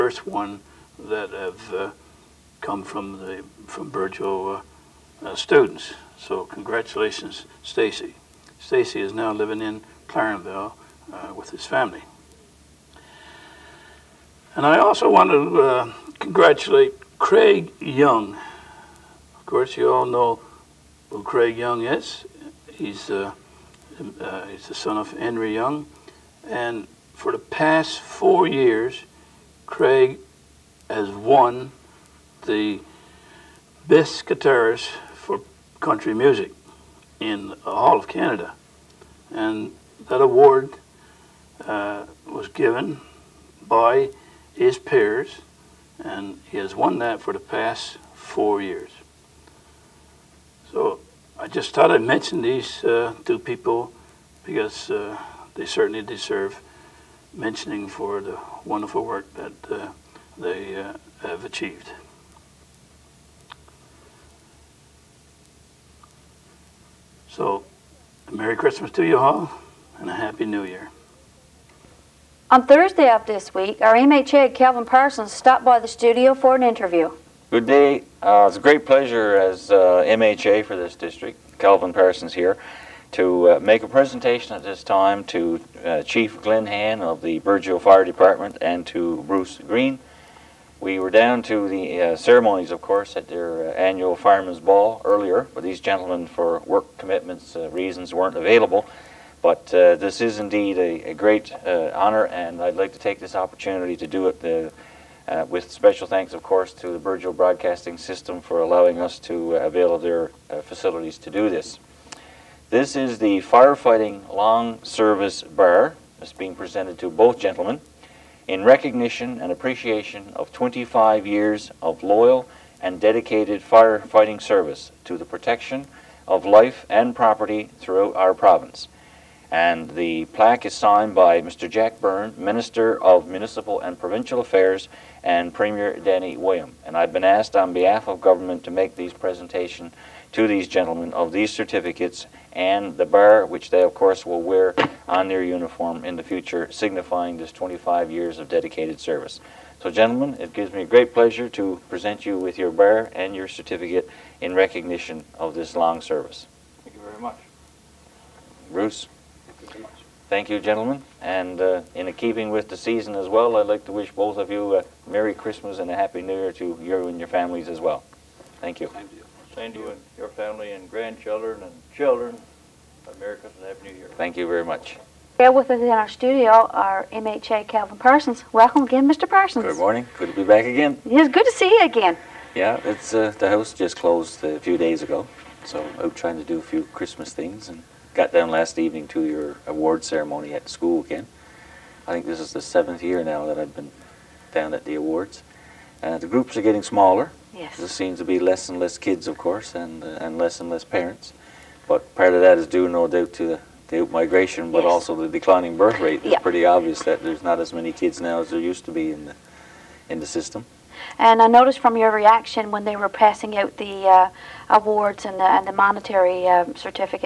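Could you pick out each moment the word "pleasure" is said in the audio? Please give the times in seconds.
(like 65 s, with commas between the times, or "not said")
78 s, 151 s.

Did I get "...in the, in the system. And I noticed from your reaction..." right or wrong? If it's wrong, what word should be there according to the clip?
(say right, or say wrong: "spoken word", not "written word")
right.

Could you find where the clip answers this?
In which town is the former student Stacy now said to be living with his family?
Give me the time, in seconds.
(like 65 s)
10 s.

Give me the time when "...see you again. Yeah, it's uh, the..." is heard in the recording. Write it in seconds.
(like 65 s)
181 s.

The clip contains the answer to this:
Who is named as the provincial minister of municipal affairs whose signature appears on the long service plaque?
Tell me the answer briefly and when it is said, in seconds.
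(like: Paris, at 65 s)
Jack Byrne, at 131 s.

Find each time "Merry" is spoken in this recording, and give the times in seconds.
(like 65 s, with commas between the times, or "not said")
68 s, 165 s, 173 s.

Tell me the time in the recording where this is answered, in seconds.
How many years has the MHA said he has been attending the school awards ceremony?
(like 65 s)
192 s.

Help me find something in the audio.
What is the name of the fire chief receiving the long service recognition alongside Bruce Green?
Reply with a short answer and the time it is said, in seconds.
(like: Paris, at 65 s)
Glenn Han, at 86 s.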